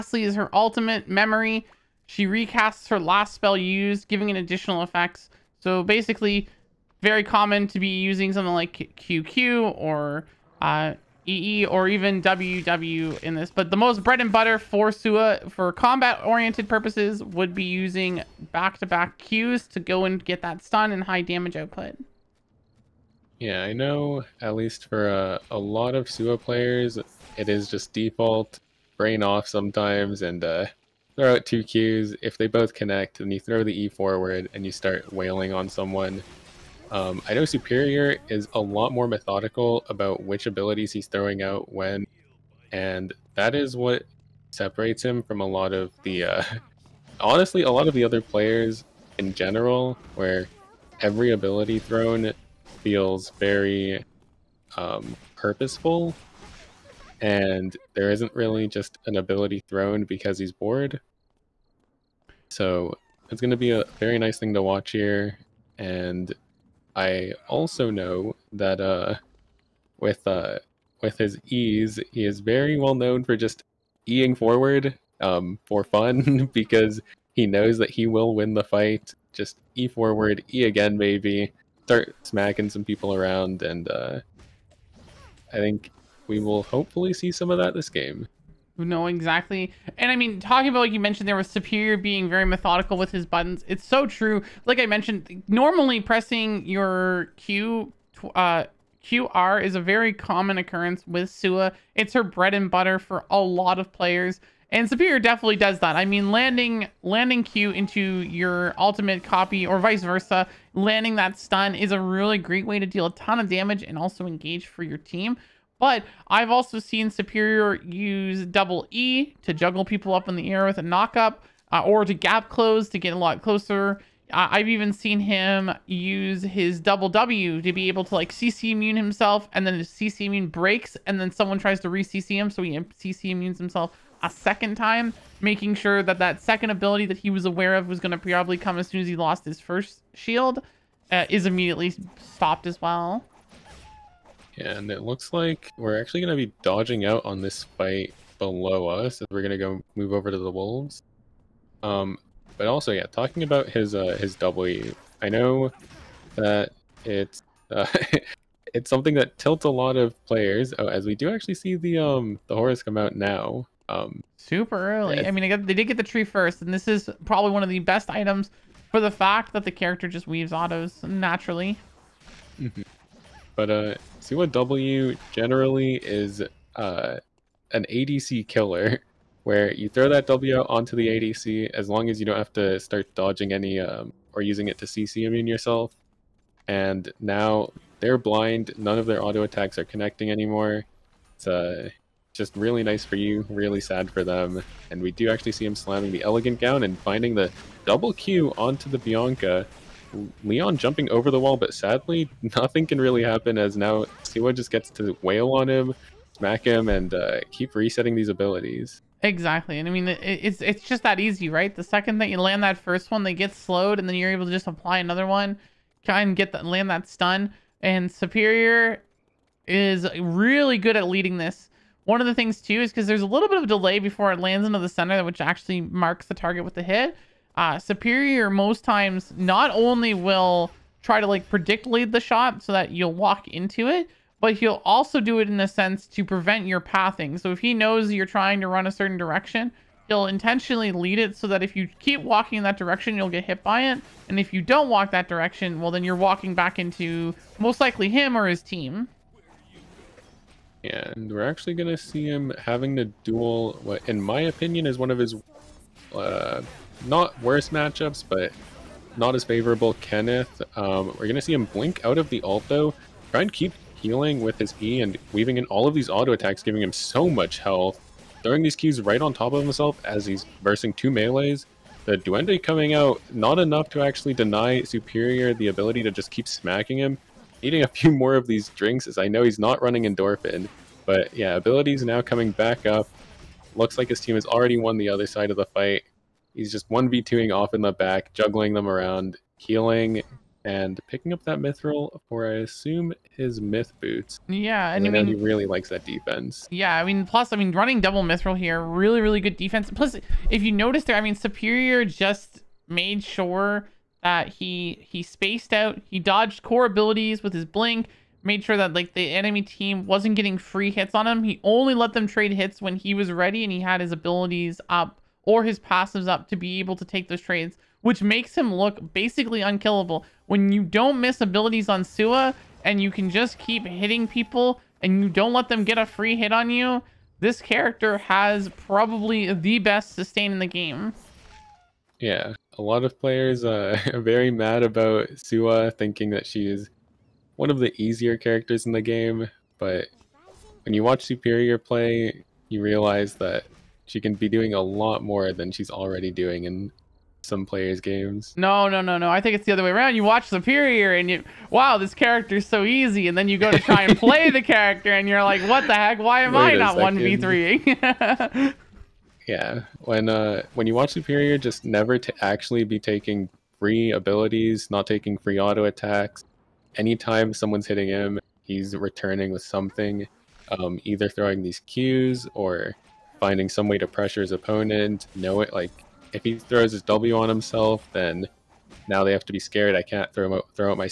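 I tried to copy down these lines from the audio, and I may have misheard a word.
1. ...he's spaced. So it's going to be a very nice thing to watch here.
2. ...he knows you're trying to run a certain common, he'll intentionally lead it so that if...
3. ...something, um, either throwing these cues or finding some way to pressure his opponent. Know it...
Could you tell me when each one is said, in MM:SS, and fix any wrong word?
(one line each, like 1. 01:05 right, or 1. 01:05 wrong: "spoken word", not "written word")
1. 01:00 wrong: "bored", not "spaced"
2. 03:57 wrong: "direction", not "common"
3. 06:09 right.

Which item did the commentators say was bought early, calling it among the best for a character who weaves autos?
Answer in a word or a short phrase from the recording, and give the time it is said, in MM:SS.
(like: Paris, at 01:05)
Horus, at 02:42.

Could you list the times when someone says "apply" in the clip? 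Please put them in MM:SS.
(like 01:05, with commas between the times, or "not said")
03:34.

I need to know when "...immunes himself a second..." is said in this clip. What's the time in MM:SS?
02:13.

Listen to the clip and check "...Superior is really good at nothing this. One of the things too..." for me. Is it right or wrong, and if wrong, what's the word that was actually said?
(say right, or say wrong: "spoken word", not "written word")
wrong: "leading", not "nothing".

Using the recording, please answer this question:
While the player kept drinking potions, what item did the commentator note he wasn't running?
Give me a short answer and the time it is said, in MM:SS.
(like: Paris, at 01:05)
Endorphin, at 04:40.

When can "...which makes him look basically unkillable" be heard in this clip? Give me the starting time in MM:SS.
05:18.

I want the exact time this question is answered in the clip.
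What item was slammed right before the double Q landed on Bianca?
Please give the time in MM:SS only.
03:16.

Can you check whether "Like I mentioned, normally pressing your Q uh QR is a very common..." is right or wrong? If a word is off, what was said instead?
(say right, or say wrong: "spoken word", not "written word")
right.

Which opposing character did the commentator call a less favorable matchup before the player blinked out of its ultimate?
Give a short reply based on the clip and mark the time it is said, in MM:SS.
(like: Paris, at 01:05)
Kenneth, at 04:20.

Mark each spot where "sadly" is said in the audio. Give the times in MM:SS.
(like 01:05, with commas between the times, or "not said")
03:21.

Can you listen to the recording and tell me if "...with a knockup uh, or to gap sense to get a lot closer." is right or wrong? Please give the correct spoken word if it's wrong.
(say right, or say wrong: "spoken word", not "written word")
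wrong: "close", not "sense".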